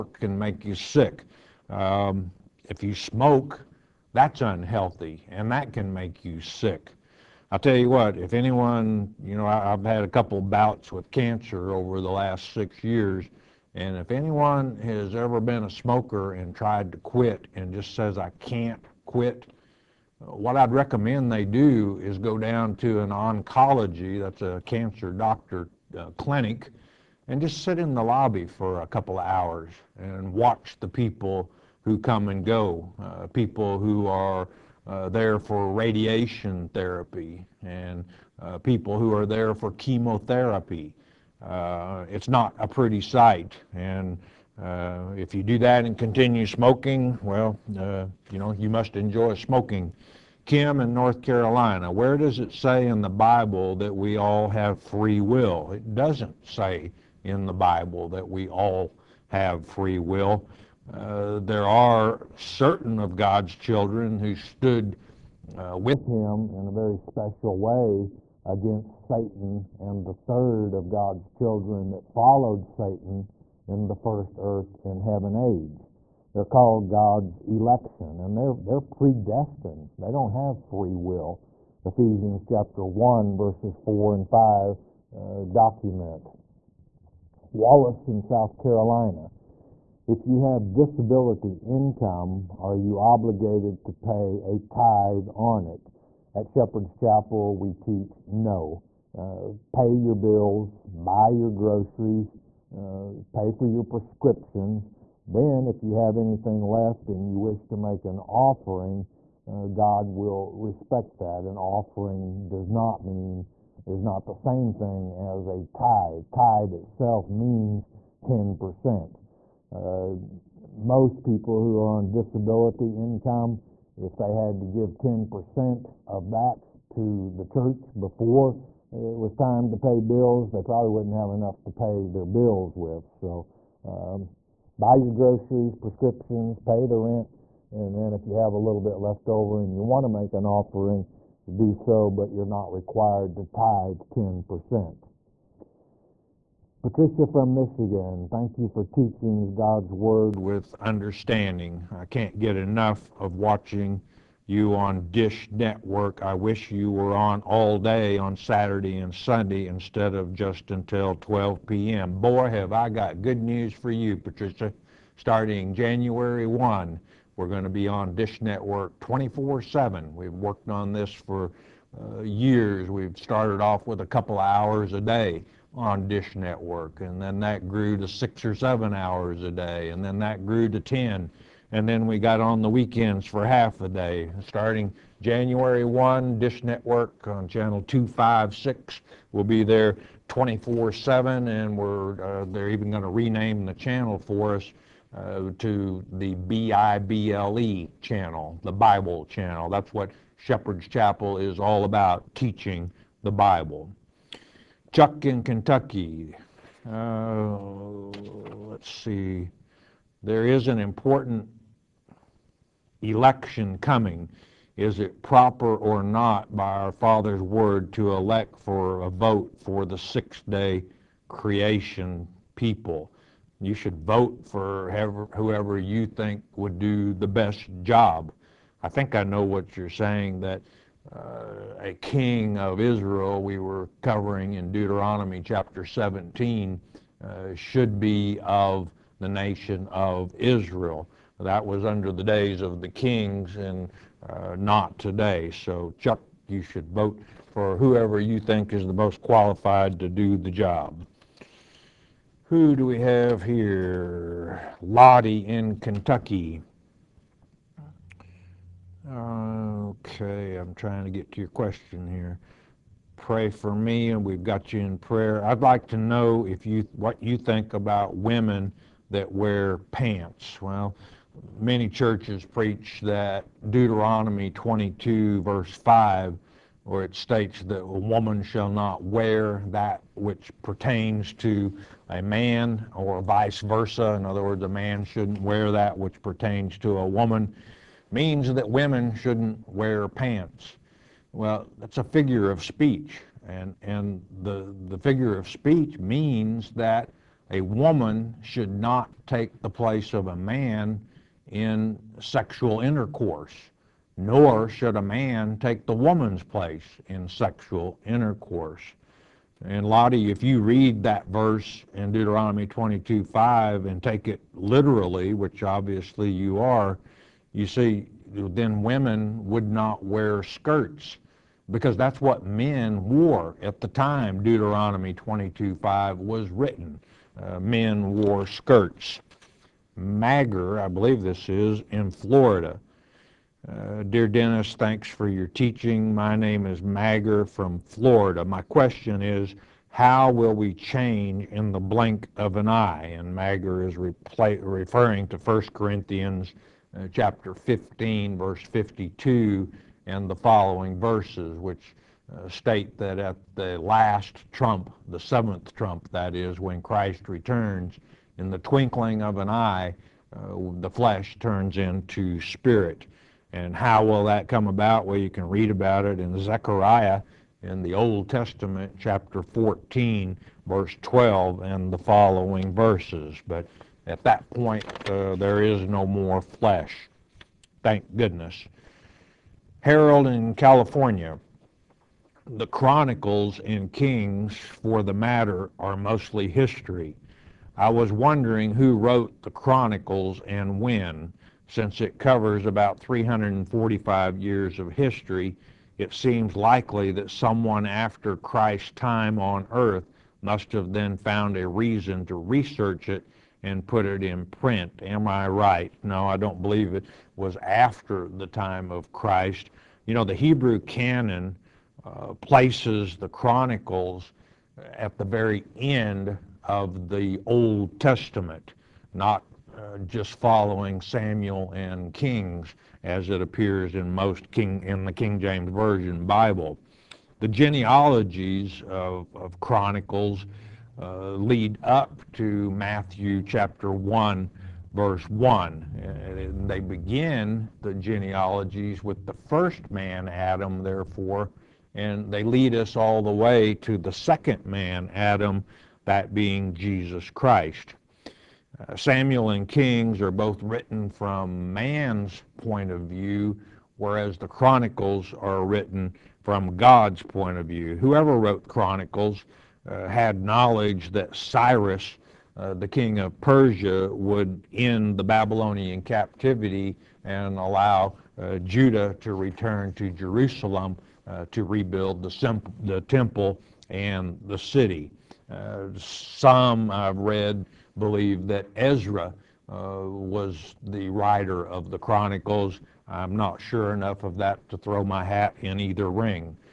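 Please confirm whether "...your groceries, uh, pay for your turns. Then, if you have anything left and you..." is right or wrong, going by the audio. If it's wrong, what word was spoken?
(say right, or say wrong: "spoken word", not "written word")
wrong: "prescriptions", not "turns".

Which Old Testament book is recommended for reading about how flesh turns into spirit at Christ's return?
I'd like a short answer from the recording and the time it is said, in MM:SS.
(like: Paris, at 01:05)
Zechariah, at 06:06.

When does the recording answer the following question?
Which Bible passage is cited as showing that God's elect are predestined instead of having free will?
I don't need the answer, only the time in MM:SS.
01:21.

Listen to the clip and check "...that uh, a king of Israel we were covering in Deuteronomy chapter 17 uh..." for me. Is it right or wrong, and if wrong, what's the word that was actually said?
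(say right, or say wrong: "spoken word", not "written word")
right.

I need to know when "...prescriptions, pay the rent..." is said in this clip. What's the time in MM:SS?
02:15.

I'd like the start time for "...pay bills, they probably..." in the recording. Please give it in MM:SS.
02:09.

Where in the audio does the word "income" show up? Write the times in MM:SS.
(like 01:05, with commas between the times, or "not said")
01:31, 02:02.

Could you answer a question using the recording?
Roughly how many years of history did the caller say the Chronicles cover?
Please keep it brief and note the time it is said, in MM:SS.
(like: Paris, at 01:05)
345, at 06:32.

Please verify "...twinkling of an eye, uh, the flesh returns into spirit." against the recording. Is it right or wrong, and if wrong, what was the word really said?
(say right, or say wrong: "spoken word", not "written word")
wrong: "turns", not "returns".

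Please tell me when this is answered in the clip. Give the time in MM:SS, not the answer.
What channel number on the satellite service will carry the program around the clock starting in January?
03:07.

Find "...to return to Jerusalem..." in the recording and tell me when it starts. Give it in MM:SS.
07:49.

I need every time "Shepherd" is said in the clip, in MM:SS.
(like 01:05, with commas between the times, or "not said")
01:36, 03:20.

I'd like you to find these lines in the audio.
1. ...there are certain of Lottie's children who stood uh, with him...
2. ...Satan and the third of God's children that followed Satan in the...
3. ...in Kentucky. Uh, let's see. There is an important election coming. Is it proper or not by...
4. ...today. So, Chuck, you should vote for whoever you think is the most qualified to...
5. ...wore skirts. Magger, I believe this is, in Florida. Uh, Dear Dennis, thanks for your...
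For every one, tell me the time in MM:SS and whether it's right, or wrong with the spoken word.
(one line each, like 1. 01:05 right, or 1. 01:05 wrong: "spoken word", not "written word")
1. 01:01 wrong: "God", not "Lottie"
2. 01:09 right
3. 03:25 right
4. 04:04 right
5. 05:28 right.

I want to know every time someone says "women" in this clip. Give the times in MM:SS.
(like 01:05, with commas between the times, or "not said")
04:28, 04:48, 05:18.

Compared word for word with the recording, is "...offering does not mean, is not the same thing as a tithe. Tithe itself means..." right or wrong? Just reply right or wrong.
right.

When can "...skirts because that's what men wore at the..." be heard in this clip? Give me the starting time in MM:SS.
05:20.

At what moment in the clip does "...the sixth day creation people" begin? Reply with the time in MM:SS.
03:39.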